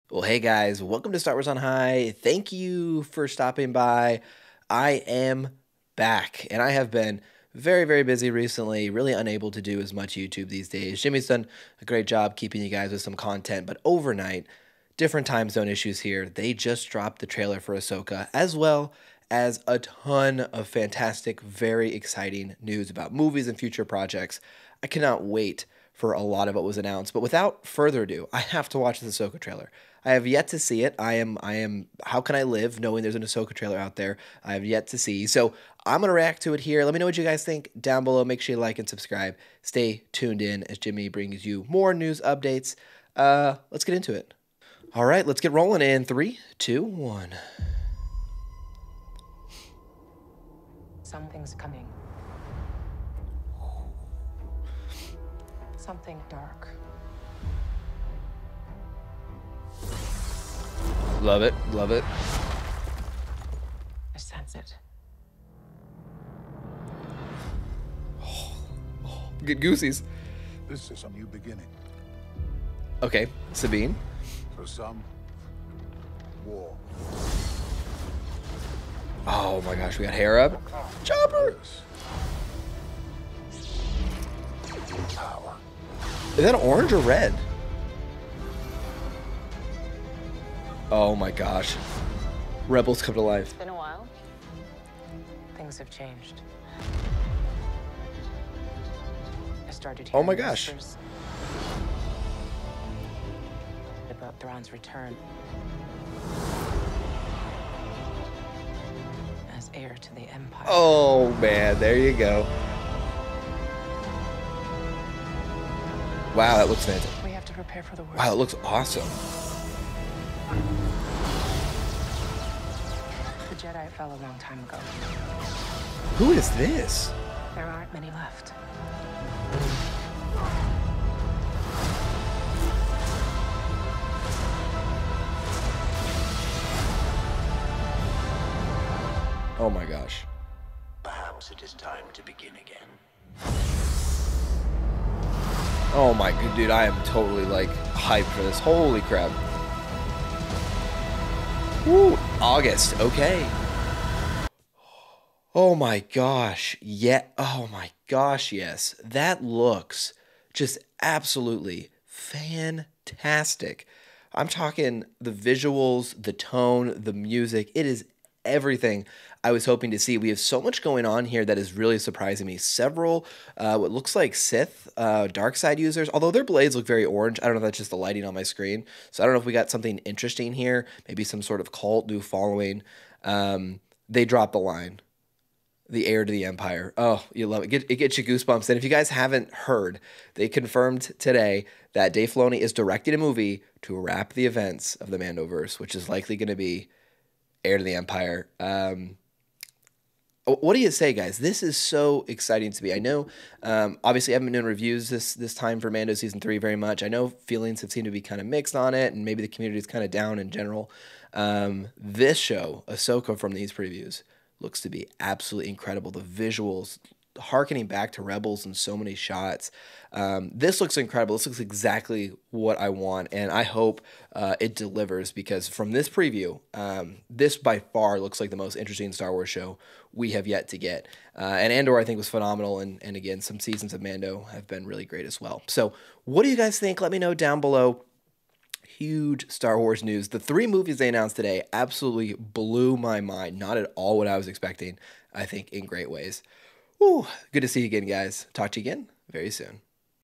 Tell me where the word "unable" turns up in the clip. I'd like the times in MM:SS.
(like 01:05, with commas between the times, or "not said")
00:09.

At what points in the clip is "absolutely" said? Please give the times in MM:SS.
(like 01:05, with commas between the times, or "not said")
02:41, 03:35, 04:01.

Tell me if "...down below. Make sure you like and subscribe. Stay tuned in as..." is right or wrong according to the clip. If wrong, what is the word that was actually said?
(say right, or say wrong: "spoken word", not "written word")
right.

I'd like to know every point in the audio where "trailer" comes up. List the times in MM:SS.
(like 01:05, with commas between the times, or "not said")
00:17, 00:29, 00:33.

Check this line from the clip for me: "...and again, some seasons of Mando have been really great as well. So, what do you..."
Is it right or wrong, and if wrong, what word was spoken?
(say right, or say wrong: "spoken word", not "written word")
right.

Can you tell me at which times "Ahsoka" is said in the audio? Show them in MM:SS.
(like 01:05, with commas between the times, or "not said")
00:17, 00:29, 00:33, 03:32.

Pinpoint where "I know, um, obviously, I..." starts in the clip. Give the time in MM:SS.
03:22.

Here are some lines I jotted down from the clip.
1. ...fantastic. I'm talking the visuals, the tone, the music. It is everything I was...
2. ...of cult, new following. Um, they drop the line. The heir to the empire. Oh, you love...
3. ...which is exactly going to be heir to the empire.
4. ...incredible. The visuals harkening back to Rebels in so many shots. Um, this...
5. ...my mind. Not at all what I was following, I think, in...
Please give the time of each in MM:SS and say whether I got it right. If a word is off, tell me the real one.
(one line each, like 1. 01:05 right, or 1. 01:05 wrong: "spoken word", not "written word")
1. 02:42 right
2. 03:01 right
3. 03:15 wrong: "likely", not "exactly"
4. 03:35 right
5. 04:02 wrong: "expecting", not "following".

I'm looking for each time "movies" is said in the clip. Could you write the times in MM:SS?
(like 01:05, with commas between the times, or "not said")
00:23, 03:13, 04:00.